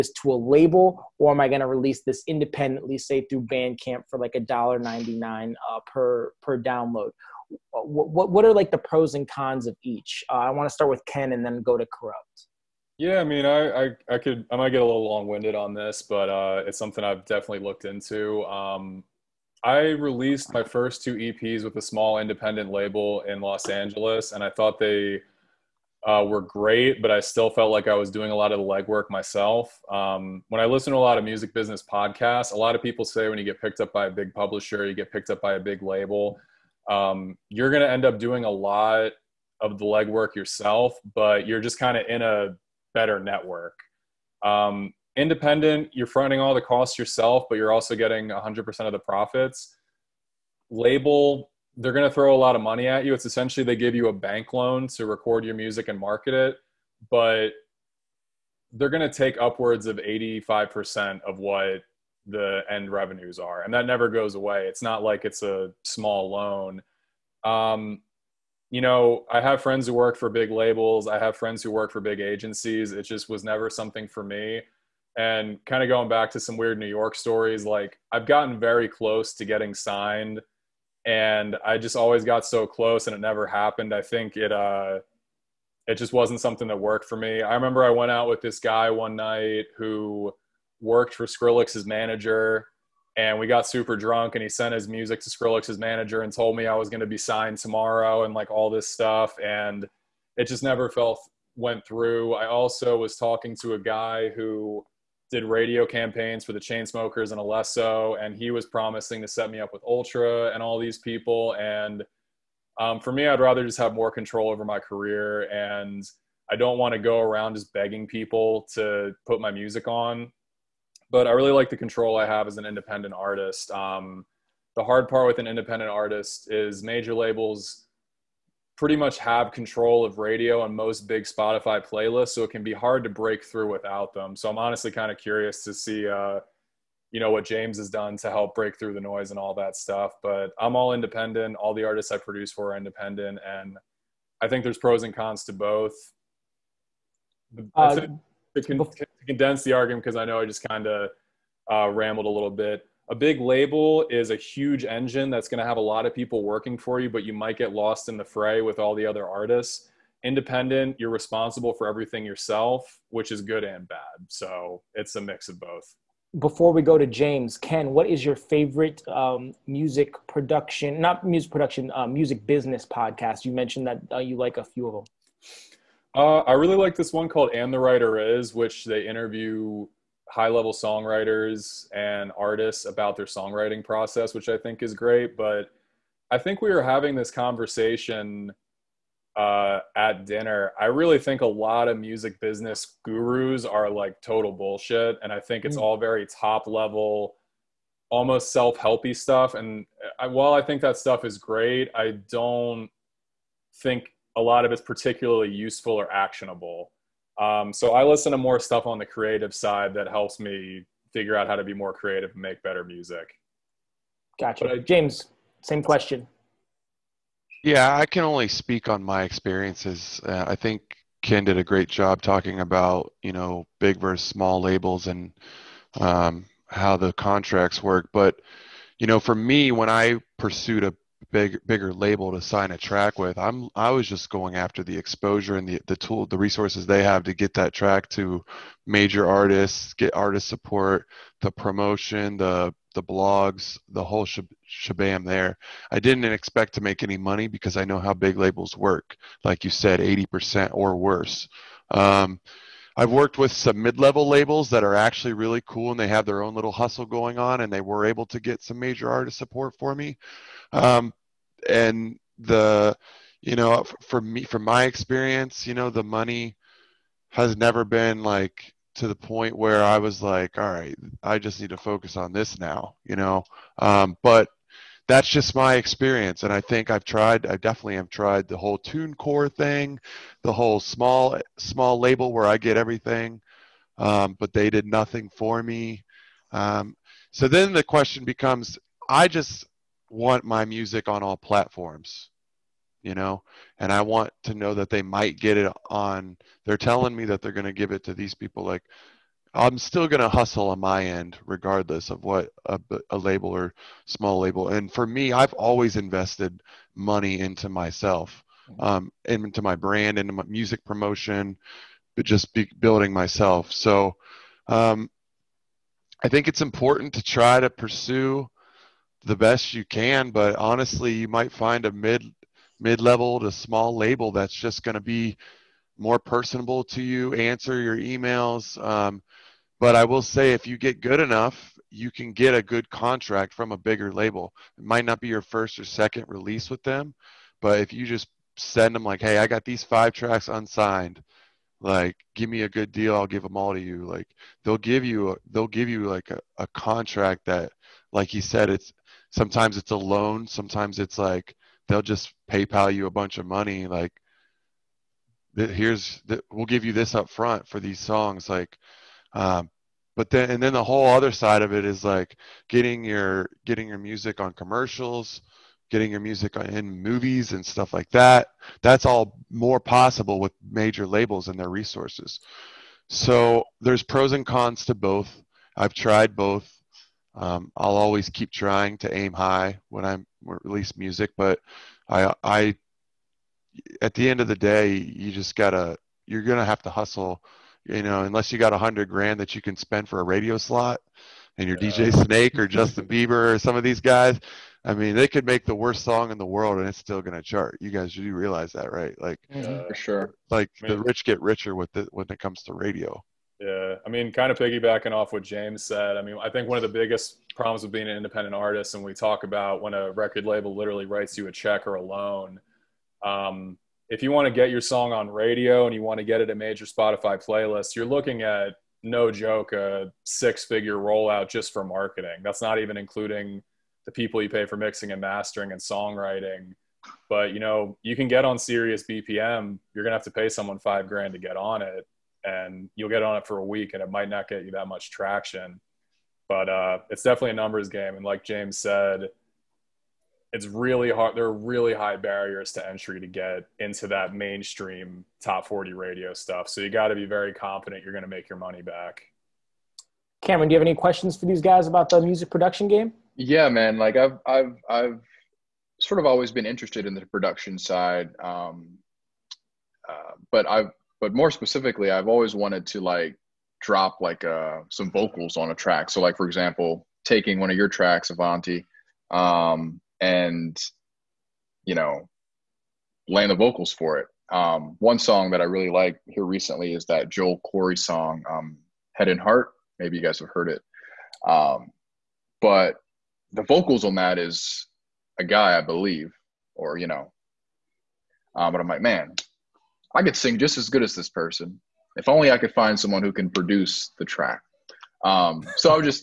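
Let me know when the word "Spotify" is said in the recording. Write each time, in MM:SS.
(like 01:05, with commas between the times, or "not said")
02:11, 06:56.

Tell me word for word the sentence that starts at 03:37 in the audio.
Yeah, I can only speak on my experiences.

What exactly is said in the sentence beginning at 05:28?
Um, but I will say, if you get good enough, you can get a good contract from a bigger label.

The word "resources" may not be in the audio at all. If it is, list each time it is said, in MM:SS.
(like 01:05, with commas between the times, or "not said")
03:56, 06:11.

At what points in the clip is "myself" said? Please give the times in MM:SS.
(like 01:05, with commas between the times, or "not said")
00:29, 05:07, 05:13.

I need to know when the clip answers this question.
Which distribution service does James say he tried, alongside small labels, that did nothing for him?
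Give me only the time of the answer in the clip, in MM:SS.
04:38.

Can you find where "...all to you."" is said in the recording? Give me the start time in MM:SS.
05:43.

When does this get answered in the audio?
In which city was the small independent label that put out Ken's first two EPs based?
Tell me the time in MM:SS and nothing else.
00:23.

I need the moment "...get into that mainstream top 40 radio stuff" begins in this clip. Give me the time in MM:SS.
07:23.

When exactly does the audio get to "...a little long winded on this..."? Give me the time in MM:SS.
00:14.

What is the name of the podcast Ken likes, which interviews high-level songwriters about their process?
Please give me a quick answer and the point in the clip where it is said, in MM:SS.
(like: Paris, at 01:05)
And the Writer Is, at 02:57.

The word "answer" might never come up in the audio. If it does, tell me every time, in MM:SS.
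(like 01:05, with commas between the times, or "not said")
05:27.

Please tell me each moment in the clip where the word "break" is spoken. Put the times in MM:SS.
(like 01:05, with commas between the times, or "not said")
02:13, 02:18.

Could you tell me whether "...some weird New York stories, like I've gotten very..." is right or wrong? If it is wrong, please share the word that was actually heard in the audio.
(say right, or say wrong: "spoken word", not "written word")
right.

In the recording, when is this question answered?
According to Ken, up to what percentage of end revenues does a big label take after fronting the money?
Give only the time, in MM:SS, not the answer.
00:59.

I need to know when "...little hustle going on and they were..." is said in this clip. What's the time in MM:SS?
04:16.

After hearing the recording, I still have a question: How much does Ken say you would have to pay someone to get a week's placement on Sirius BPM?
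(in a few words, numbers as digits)
5 grand.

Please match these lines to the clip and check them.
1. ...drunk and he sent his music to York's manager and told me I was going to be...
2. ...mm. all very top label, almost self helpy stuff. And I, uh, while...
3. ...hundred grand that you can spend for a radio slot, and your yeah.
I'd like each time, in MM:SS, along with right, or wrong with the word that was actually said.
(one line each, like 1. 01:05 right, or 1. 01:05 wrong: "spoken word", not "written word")
1. 01:33 wrong: "Skrillex", not "York"
2. 03:15 wrong: "level", not "label"
3. 06:28 right.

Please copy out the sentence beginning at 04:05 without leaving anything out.
I didn't expect to make any money because I know how big labels work.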